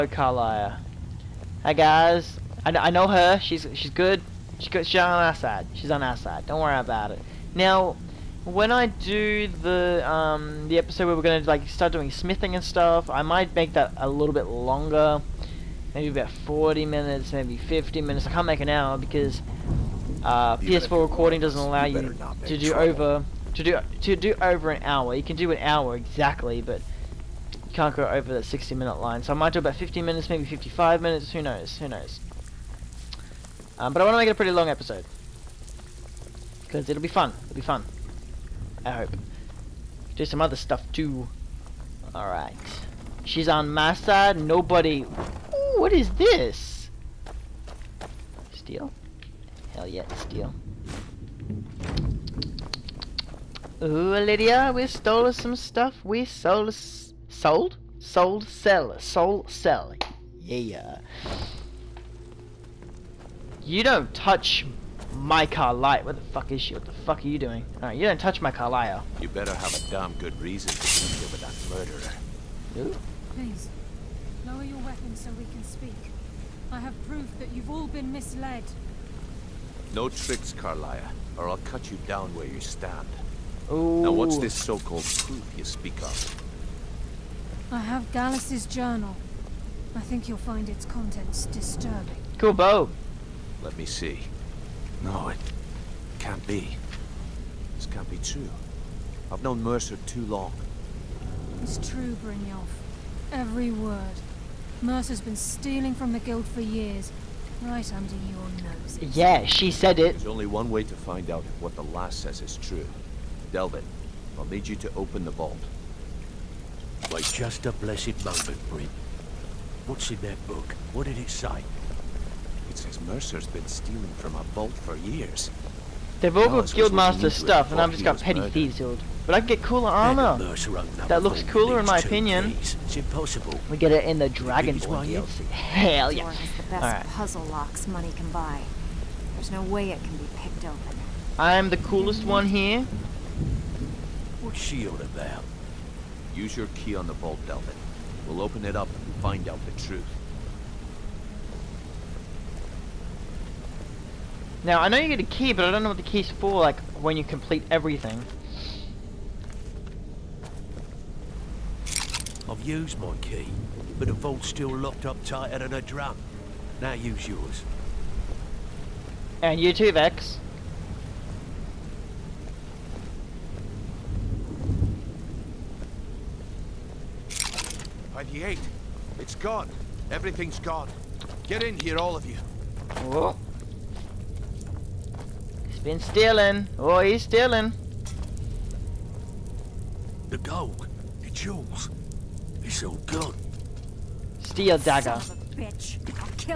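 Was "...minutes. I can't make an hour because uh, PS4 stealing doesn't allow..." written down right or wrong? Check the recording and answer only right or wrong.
wrong.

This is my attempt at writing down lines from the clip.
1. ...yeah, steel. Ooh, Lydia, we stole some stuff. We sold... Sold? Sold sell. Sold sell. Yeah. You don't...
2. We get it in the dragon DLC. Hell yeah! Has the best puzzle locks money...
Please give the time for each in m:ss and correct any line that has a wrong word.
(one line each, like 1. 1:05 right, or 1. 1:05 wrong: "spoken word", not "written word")
1. 0:49 right
2. 2:13 right.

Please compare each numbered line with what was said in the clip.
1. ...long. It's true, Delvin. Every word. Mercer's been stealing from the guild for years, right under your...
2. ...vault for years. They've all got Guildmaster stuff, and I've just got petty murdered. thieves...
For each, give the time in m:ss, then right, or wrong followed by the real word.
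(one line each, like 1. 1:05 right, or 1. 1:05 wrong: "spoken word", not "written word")
1. 1:40 wrong: "Brynjolf", not "Delvin"
2. 2:04 right.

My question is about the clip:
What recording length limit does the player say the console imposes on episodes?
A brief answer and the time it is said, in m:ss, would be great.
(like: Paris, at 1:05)
60 minutes, at 0:28.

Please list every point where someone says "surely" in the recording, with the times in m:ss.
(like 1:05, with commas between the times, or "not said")
not said.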